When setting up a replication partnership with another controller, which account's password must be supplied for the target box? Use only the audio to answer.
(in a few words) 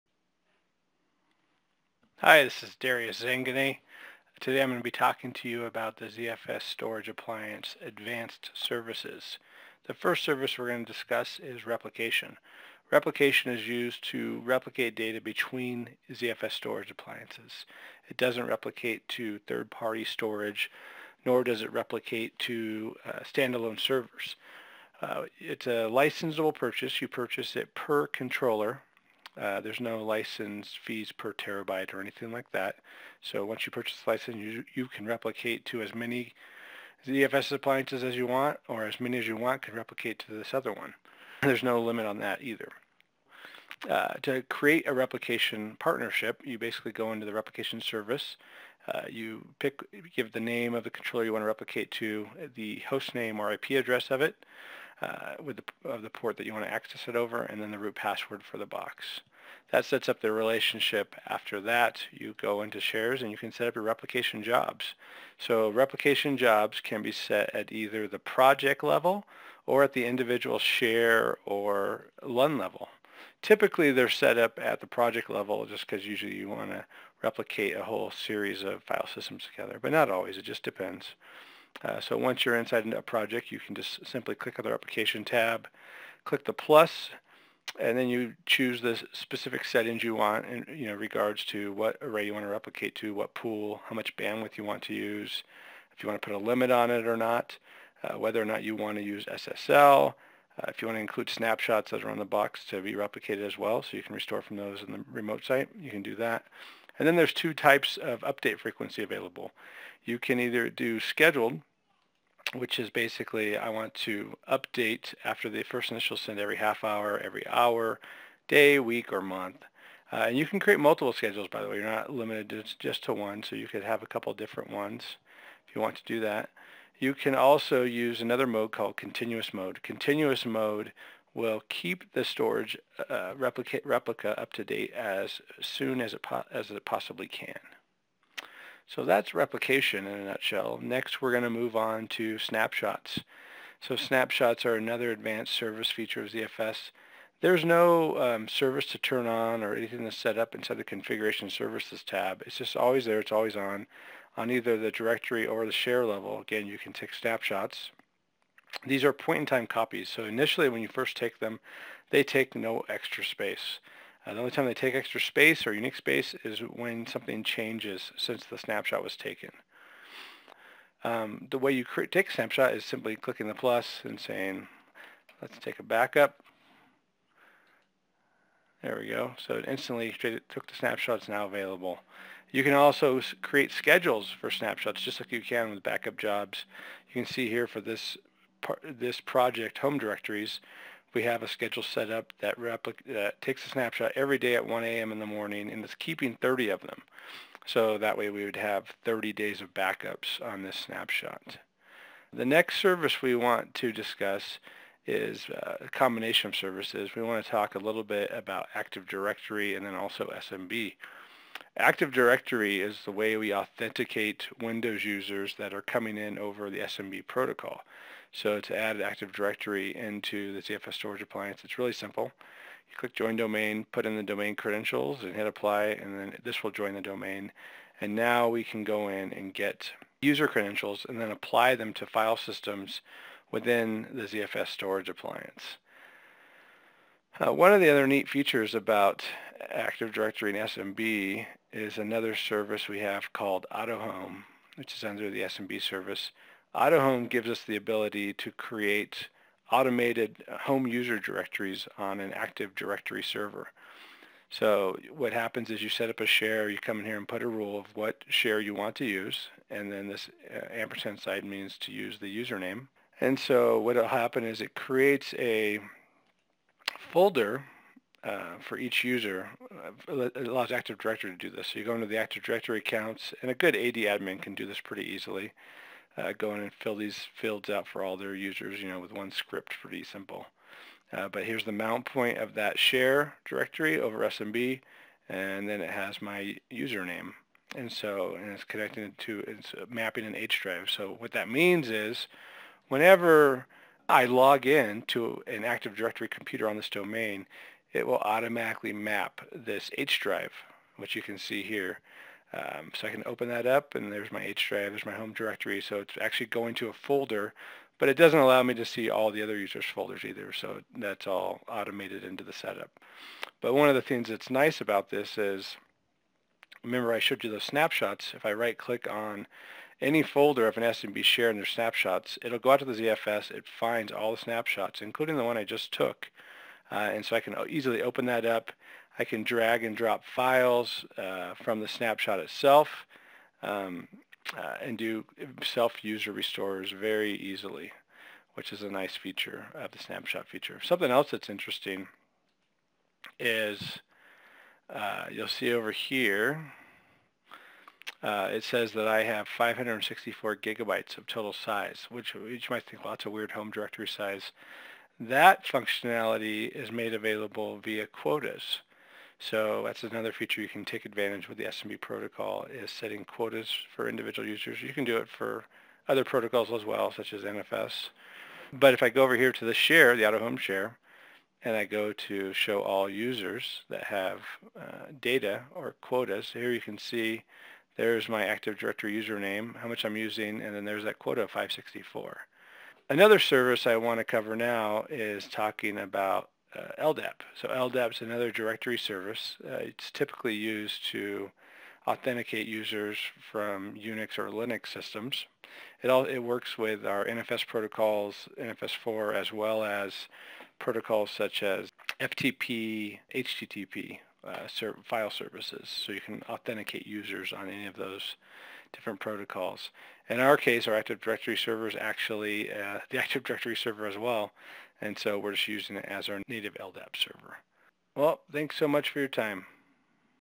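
root.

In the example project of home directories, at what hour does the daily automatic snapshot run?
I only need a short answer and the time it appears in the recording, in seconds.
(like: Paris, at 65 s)
1 a.m., at 194 s.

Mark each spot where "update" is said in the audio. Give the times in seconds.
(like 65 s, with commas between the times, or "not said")
108 s, 114 s.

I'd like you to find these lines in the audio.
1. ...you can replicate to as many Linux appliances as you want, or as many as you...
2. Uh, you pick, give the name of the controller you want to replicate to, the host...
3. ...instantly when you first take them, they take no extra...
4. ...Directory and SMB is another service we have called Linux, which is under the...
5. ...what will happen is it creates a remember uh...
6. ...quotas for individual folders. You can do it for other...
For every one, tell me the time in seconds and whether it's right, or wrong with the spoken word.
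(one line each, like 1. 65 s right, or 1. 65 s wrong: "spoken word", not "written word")
1. 34 s wrong: "ZFS", not "Linux"
2. 48 s right
3. 160 s wrong: "initially", not "instantly"
4. 240 s wrong: "AutoHome", not "Linux"
5. 263 s wrong: "folder", not "remember"
6. 363 s wrong: "users", not "folders".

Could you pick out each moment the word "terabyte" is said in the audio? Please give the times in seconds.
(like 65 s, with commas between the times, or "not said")
31 s.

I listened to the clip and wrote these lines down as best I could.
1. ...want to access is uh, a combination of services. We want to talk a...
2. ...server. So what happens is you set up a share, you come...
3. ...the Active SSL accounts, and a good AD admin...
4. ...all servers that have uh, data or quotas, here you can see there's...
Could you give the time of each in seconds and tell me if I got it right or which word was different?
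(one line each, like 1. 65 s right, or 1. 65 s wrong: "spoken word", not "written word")
1. 203 s wrong: "discuss", not "access"
2. 253 s right
3. 272 s wrong: "Directory", not "SSL"
4. 372 s wrong: "users", not "servers".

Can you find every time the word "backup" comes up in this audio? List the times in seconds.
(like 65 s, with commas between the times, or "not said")
175 s, 185 s, 199 s.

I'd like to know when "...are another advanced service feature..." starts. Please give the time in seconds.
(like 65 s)
144 s.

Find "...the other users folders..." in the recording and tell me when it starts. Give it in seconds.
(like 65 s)
309 s.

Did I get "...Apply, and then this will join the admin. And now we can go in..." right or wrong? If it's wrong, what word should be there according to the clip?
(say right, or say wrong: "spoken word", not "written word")
wrong: "domain", not "admin".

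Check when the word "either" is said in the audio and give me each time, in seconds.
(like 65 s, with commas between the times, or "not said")
42 s, 67 s, 110 s, 154 s, 310 s.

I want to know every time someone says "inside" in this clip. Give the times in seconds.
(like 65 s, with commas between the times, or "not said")
82 s, 150 s.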